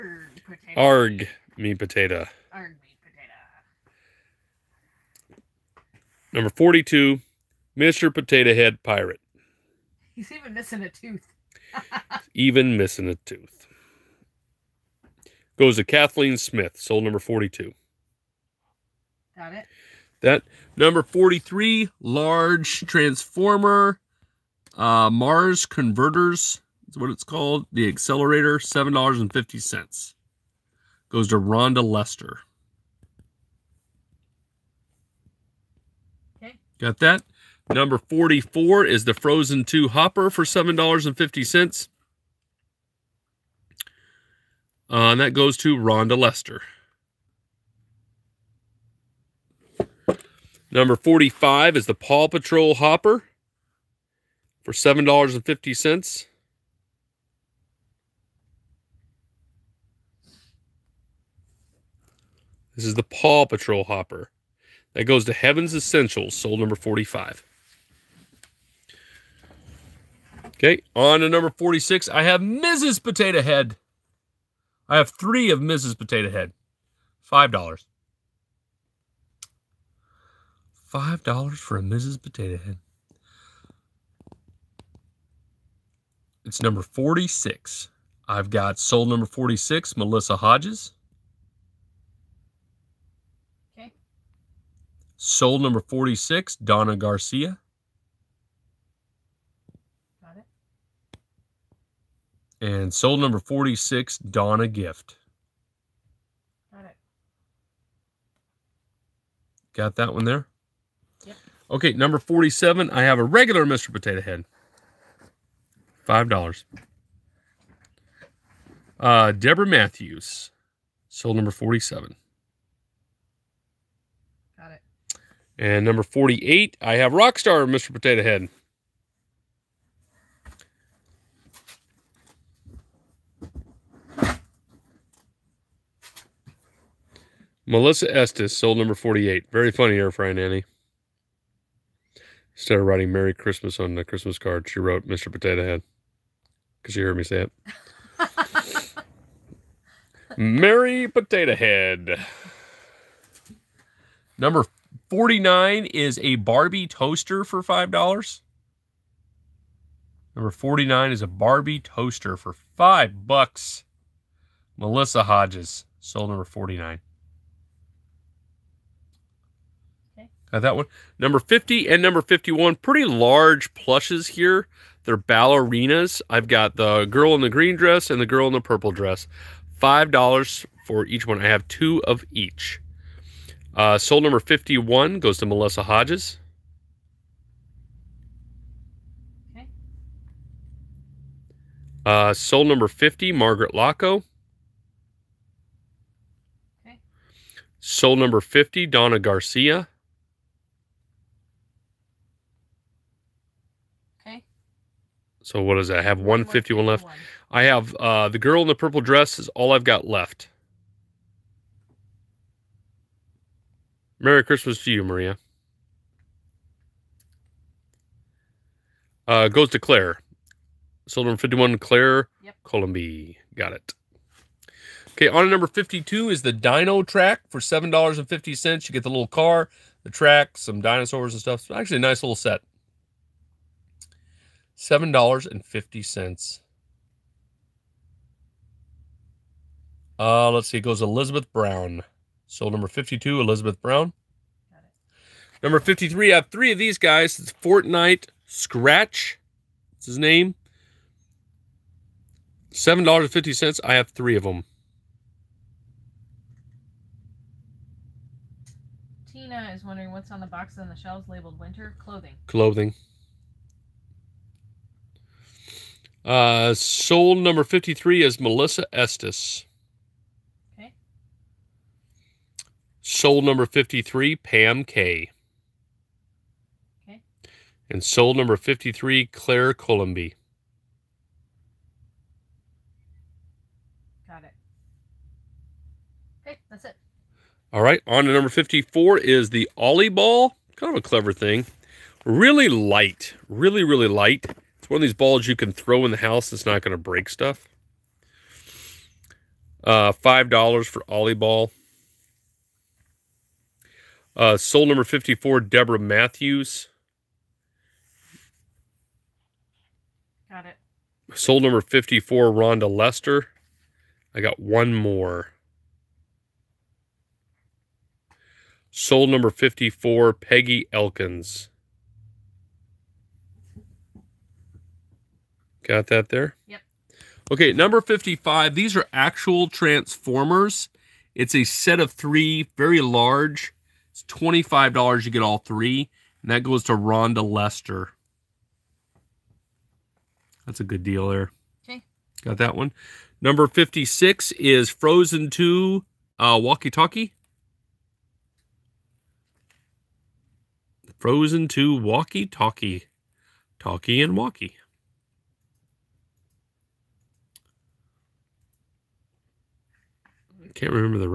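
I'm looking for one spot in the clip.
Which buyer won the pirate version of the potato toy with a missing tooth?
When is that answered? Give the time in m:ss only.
0:15.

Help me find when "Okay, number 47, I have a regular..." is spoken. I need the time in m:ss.
1:51.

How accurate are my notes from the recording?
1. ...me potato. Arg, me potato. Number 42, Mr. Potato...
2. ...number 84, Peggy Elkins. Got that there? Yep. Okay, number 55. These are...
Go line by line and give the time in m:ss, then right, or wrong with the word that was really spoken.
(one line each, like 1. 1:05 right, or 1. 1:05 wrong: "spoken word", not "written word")
1. 0:01 right
2. 5:19 wrong: "54", not "84".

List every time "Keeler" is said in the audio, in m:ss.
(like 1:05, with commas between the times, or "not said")
not said.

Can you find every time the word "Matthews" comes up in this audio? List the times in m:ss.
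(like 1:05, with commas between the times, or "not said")
1:59, 5:05.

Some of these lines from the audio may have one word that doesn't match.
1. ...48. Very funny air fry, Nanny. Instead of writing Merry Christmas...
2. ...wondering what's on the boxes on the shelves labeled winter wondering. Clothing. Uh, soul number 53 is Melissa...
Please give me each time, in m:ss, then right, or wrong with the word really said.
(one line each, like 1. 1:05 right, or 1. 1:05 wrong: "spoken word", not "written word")
1. 2:18 right
2. 4:19 wrong: "clothing", not "wondering".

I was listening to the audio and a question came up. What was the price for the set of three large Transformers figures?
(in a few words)
$25.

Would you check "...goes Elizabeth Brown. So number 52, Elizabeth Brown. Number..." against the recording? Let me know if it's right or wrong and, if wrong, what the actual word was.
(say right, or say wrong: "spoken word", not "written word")
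right.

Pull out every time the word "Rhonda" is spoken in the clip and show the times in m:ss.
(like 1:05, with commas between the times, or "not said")
0:31, 0:45, 5:12, 5:36.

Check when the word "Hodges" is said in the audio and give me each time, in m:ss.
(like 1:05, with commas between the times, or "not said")
1:30, 2:45, 3:05.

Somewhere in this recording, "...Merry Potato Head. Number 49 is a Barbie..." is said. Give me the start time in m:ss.
2:30.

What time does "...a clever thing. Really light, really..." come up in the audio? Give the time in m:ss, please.
4:50.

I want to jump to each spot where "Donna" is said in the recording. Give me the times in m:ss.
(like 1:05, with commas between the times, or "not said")
1:36, 1:44, 3:18.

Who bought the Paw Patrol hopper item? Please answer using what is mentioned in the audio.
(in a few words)
Heaven's Essentials.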